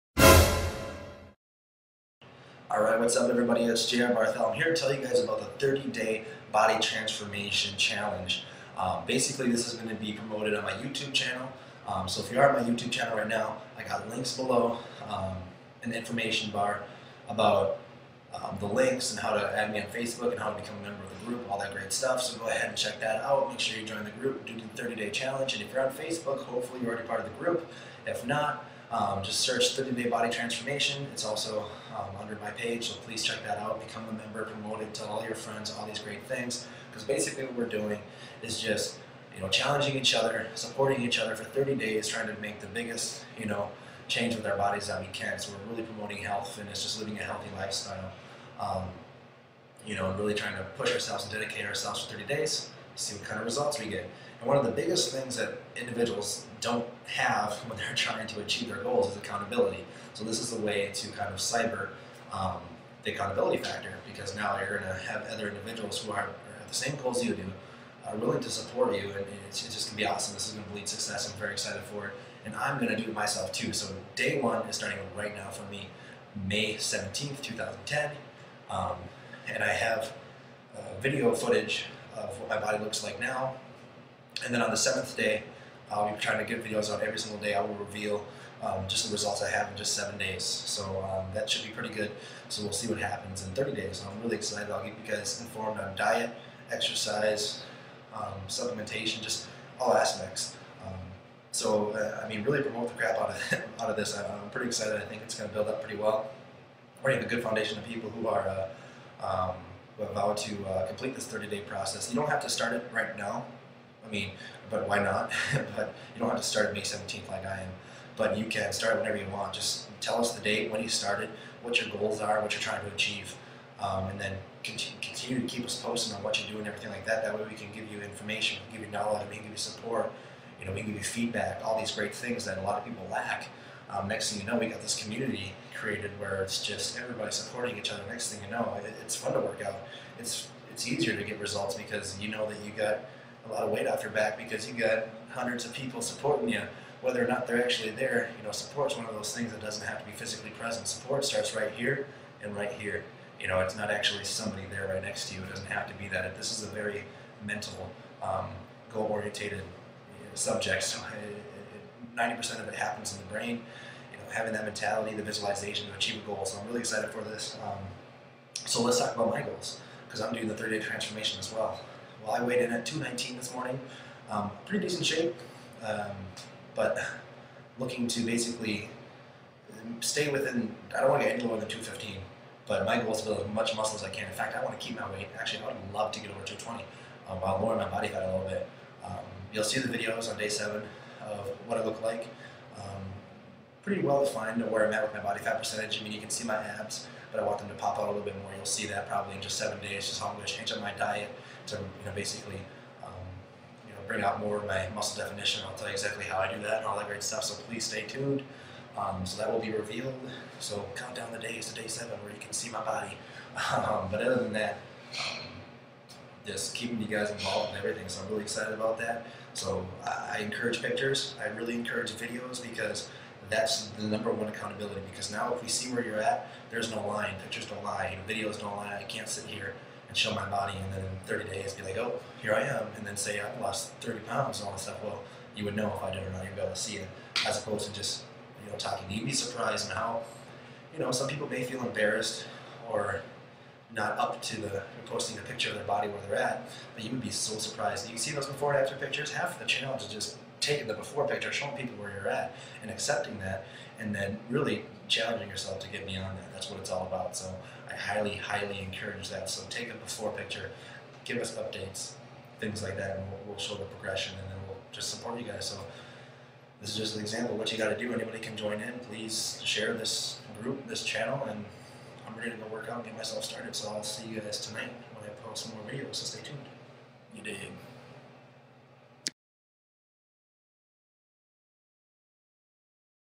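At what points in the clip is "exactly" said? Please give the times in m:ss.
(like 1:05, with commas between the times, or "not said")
3:25.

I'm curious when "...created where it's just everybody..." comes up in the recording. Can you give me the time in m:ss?
2:15.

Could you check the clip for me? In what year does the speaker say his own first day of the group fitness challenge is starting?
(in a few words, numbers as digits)
2010.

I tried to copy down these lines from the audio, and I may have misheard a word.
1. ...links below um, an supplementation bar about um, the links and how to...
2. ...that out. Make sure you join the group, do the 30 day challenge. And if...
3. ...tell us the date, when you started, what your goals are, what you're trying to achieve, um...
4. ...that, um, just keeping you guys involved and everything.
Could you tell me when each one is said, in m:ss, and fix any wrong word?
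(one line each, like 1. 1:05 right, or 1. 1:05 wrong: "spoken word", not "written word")
1. 0:14 wrong: "information", not "supplementation"
2. 0:23 right
3. 2:00 right
4. 3:34 right.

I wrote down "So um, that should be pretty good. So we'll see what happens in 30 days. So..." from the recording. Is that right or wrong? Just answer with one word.
right.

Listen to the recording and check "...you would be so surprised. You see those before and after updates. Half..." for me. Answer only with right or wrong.
wrong.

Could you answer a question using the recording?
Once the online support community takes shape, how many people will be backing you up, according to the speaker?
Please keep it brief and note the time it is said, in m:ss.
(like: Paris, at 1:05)
hundreds, at 2:25.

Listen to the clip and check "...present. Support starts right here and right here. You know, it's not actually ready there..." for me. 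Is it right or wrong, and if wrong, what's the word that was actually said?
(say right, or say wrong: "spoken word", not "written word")
wrong: "somebody", not "ready".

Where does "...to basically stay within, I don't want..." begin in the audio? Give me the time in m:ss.
2:58.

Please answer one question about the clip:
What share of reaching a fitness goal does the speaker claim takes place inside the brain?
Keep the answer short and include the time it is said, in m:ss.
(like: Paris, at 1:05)
90%, at 2:42.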